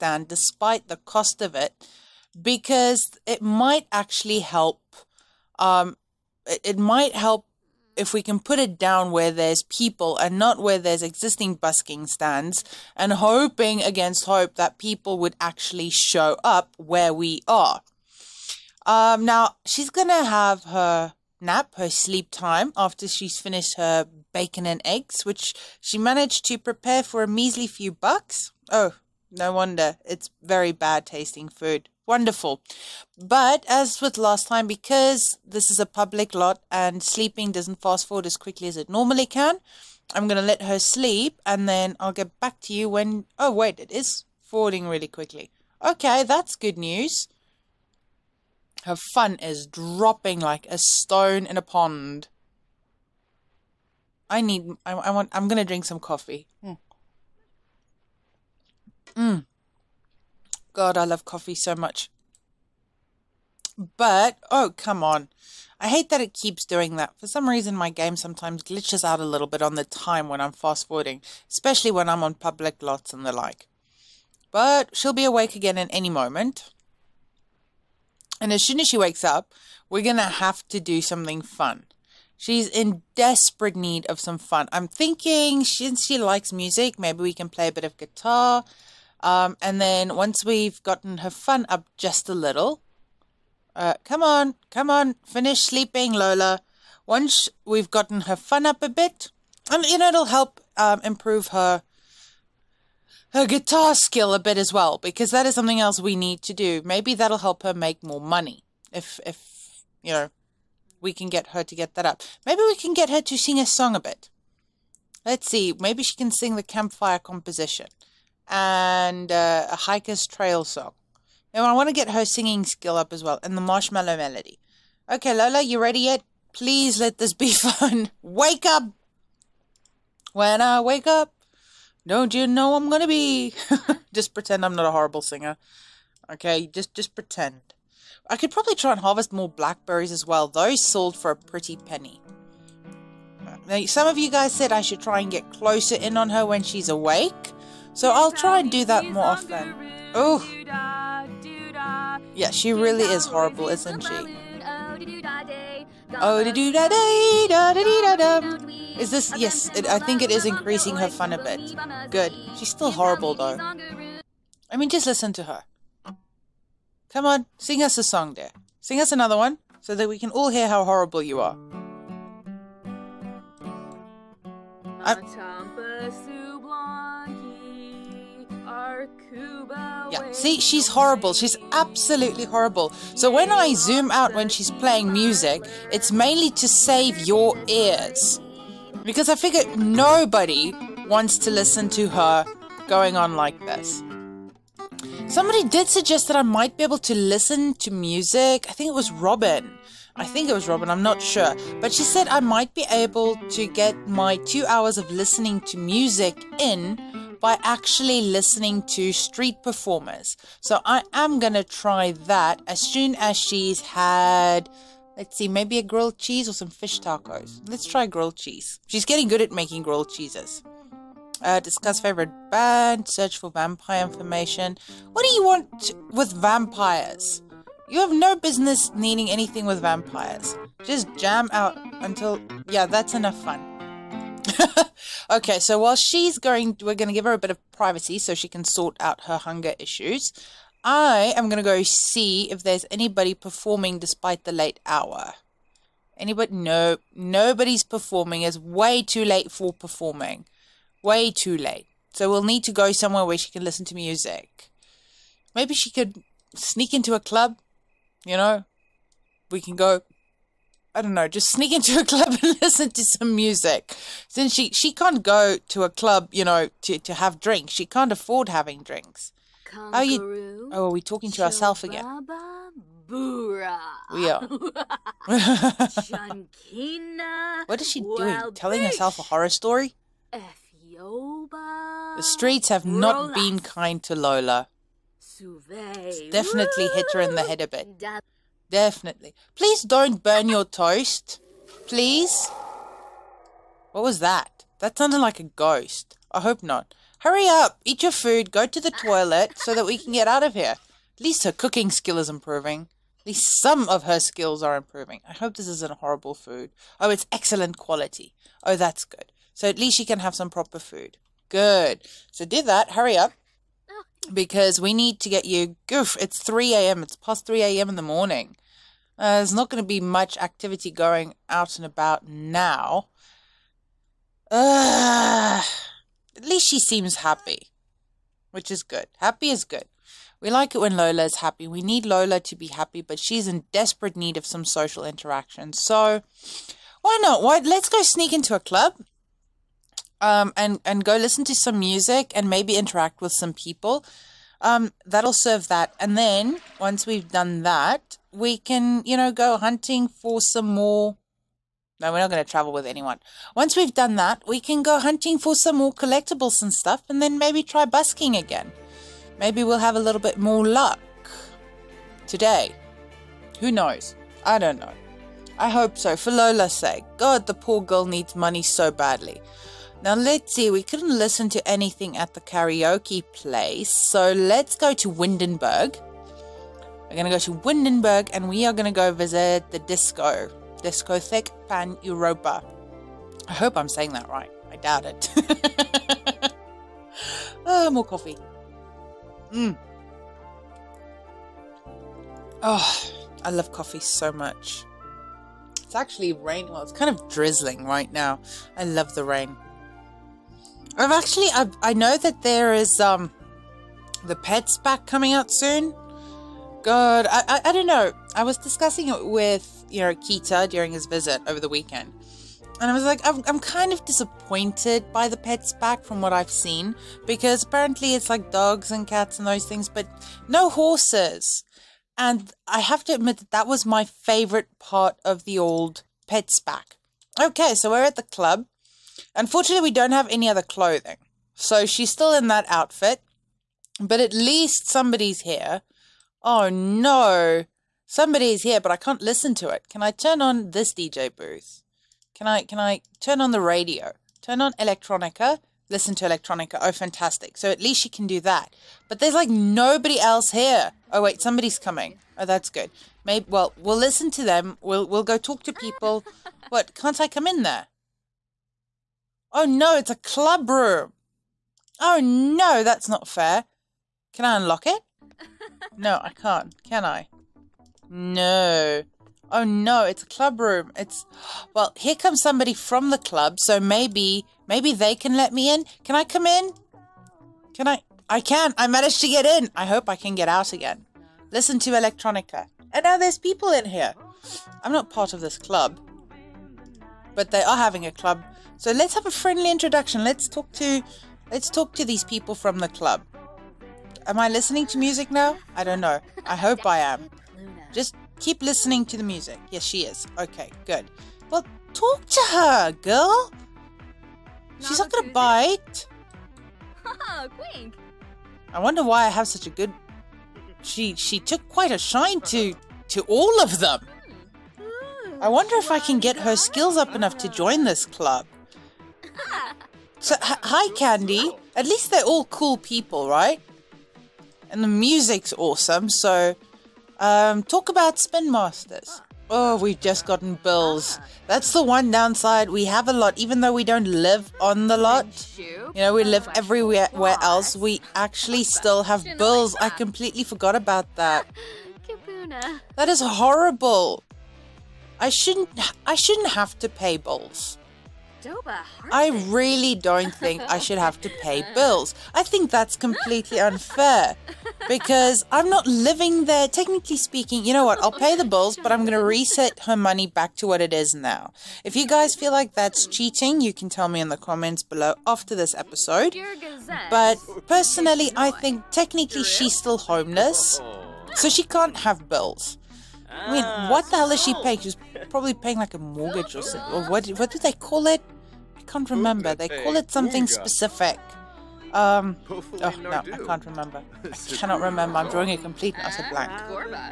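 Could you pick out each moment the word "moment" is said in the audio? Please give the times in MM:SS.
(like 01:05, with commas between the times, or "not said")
01:16.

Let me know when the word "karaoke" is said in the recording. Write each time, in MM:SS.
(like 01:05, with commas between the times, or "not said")
06:12.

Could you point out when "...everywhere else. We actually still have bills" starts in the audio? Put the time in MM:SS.
08:56.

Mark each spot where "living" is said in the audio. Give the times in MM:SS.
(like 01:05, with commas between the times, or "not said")
09:15.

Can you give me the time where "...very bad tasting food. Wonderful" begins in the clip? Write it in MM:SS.
00:30.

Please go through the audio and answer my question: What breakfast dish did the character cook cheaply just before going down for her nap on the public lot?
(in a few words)
bacon and eggs.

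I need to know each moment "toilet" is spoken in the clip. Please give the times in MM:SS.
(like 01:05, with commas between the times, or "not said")
04:59.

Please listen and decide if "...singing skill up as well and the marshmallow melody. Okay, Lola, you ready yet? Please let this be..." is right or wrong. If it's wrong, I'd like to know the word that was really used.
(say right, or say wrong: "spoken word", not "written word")
right.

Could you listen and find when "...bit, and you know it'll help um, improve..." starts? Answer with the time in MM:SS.
01:38.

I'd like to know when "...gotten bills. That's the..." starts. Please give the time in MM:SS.
08:50.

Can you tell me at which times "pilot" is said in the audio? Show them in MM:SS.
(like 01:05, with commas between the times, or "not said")
not said.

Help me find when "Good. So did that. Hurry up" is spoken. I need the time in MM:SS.
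05:11.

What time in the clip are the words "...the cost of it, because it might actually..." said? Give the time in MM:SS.
00:00.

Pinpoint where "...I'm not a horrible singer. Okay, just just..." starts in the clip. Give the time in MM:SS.
02:14.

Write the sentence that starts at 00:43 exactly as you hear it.
Oh, wait, it is forwarding really quickly.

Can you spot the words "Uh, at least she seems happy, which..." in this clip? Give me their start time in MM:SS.
05:24.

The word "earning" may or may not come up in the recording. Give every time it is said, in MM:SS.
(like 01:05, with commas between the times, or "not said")
not said.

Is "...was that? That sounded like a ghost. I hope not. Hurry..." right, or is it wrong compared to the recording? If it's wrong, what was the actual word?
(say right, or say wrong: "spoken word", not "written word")
right.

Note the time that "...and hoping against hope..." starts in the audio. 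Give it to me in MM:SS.
00:12.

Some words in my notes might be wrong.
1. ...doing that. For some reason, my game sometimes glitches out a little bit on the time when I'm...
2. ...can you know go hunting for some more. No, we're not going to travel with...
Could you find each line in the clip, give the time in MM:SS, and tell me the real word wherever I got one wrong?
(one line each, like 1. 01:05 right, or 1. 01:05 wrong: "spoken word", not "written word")
1. 01:06 right
2. 05:48 right.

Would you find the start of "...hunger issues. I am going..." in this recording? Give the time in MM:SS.
03:59.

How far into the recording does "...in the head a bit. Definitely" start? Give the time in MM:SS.
04:47.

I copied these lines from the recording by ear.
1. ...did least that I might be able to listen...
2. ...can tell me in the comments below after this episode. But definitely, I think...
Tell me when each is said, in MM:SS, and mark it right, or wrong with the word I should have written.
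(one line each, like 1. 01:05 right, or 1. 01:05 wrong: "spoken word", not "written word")
1. 03:15 wrong: "suggest", not "least"
2. 09:23 wrong: "personally", not "definitely".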